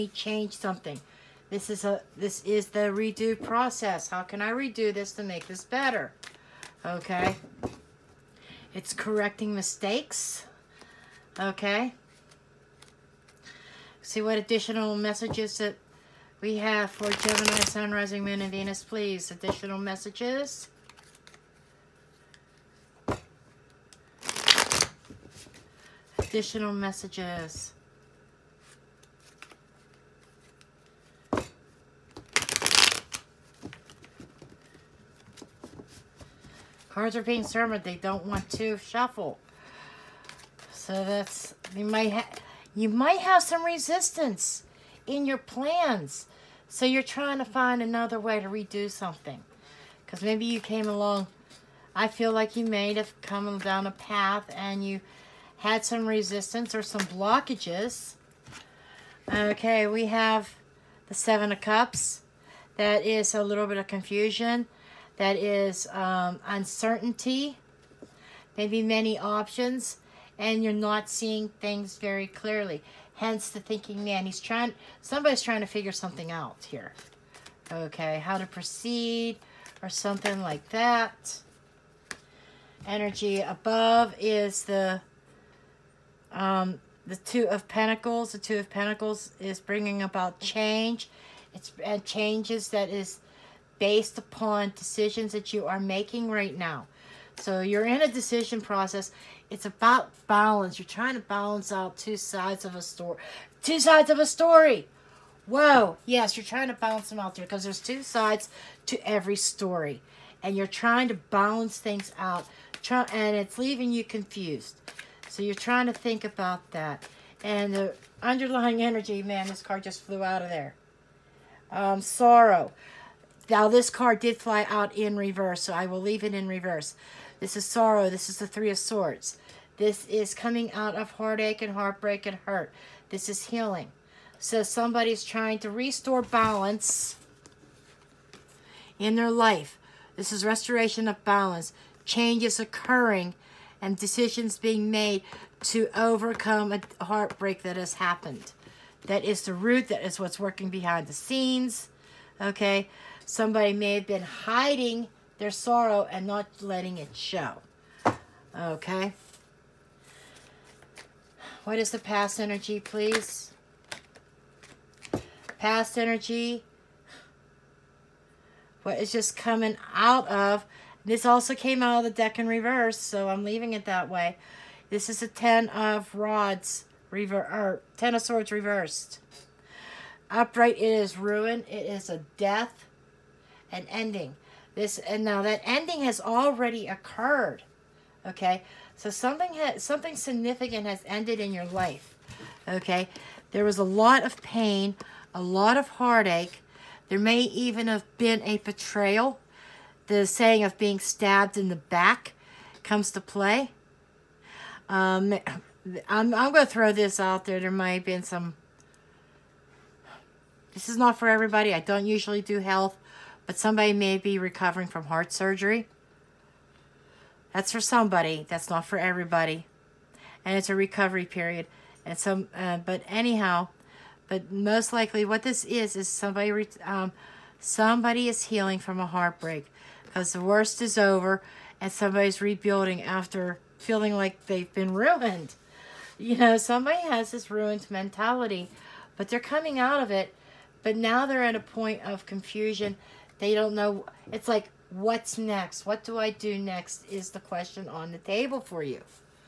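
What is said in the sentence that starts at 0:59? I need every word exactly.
Okay, we have the Seven of Cups.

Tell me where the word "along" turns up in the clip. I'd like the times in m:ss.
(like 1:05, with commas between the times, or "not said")
0:50.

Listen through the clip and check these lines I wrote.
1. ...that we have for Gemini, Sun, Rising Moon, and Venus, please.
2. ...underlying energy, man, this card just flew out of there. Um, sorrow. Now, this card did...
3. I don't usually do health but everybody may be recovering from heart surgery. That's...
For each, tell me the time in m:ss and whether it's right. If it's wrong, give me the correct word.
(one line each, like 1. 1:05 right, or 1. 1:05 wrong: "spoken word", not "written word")
1. 0:15 right
2. 1:58 right
3. 3:31 wrong: "somebody", not "everybody".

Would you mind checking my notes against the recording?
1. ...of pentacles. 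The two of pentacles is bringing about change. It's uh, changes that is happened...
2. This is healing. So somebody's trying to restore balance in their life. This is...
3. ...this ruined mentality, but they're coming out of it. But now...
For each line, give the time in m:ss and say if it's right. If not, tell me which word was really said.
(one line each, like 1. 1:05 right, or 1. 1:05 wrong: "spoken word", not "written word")
1. 1:27 wrong: "based", not "happened"
2. 2:13 right
3. 3:57 right.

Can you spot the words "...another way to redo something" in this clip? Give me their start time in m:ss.
0:47.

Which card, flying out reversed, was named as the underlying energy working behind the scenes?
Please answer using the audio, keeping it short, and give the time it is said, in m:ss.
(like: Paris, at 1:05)
Three of Swords, at 2:08.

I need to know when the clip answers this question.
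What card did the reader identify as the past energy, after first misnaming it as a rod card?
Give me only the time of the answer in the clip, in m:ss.
2:57.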